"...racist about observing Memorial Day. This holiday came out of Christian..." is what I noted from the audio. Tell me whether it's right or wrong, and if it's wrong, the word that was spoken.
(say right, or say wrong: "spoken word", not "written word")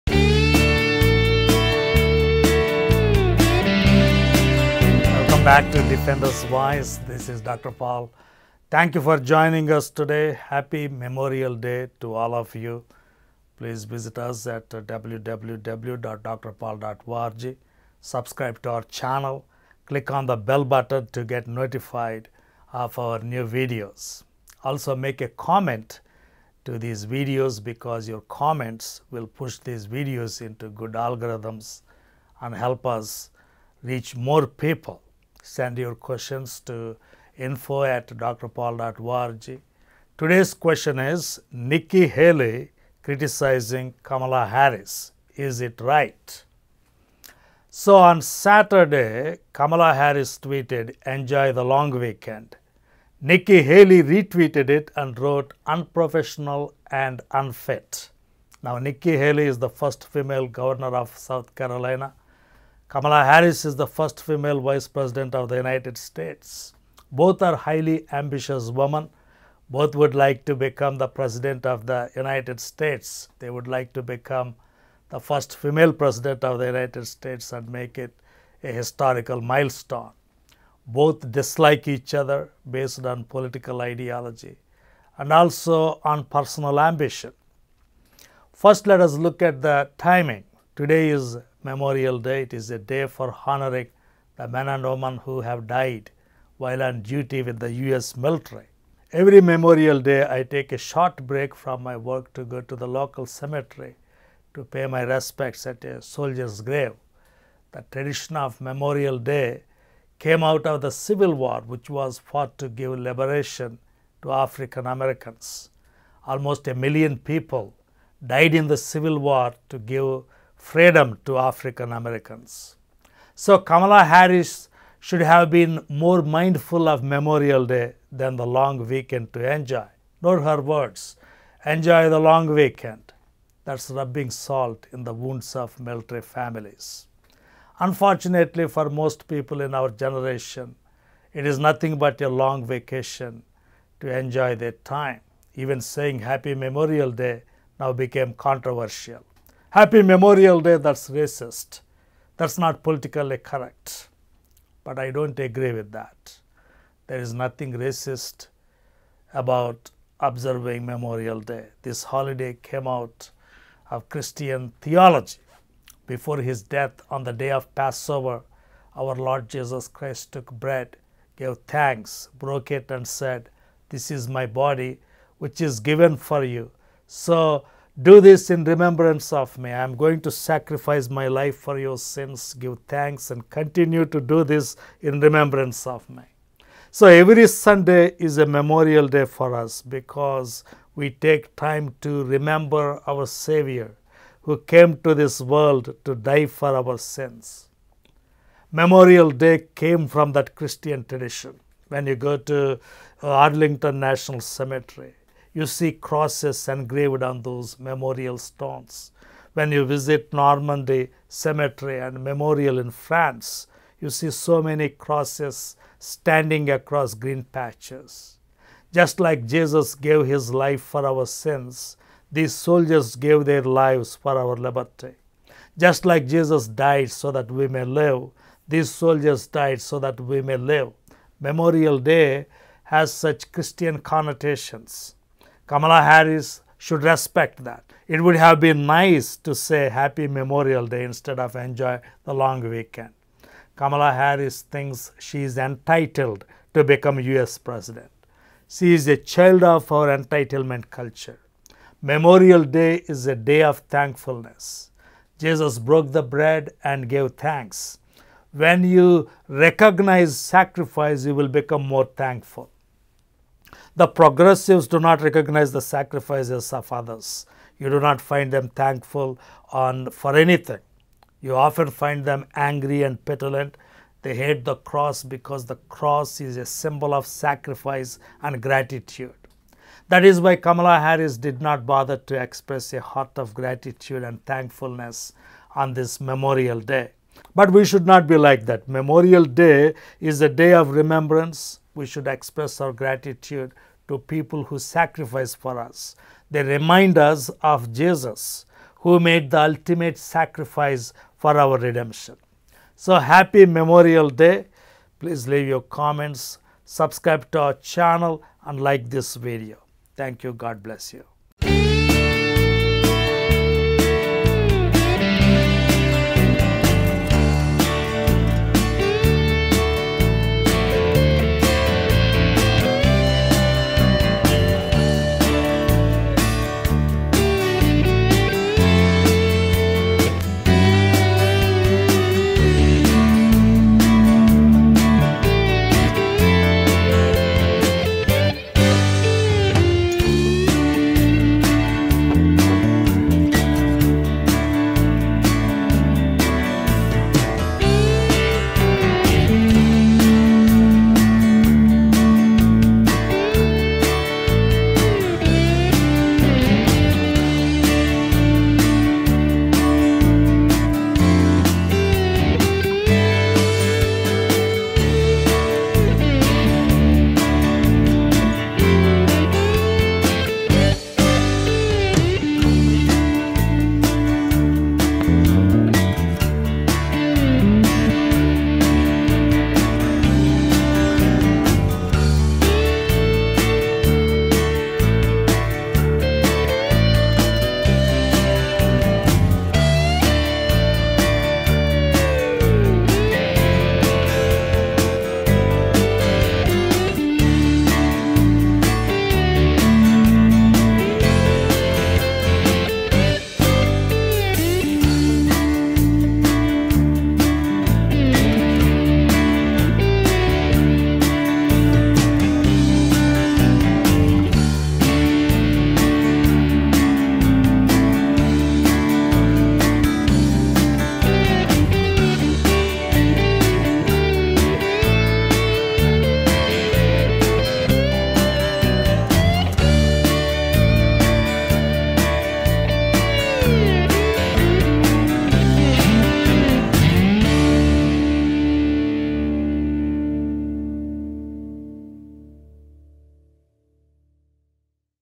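right.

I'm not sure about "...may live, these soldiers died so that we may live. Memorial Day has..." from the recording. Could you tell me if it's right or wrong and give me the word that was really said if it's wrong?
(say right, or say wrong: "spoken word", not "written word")
right.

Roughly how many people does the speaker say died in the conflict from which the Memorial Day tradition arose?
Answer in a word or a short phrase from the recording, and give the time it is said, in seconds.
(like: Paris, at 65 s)
Almost a million, at 116 s.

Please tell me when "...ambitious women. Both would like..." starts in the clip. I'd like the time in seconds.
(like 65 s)
68 s.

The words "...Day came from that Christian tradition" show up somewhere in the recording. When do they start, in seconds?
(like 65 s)
199 s.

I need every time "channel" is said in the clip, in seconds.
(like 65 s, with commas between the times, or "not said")
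18 s, 307 s.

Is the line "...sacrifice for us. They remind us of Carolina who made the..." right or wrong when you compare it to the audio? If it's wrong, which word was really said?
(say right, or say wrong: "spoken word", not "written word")
wrong: "Jesus", not "Carolina".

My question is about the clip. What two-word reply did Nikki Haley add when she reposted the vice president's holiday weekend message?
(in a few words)
Unprofessional and unfit.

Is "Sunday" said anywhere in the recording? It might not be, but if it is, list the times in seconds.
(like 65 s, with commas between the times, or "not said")
187 s.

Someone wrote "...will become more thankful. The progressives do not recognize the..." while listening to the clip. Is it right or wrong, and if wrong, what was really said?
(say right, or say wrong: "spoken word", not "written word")
right.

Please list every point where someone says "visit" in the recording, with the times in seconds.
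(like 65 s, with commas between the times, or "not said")
13 s, 209 s.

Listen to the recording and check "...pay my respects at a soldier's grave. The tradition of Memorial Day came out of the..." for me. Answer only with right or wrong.
right.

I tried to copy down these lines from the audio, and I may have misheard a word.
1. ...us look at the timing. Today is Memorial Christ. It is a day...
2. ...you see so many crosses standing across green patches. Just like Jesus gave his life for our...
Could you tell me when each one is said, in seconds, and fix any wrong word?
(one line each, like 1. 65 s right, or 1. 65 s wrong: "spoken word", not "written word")
1. 88 s wrong: "Day", not "Christ"
2. 213 s right.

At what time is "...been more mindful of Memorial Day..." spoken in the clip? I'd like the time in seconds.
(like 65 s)
125 s.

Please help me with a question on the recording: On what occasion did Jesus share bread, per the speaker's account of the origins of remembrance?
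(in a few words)
Passover.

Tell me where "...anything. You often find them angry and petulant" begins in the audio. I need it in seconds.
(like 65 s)
270 s.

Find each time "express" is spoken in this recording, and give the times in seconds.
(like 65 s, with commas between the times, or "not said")
282 s, 292 s.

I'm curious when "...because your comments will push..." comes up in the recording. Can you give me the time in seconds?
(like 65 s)
27 s.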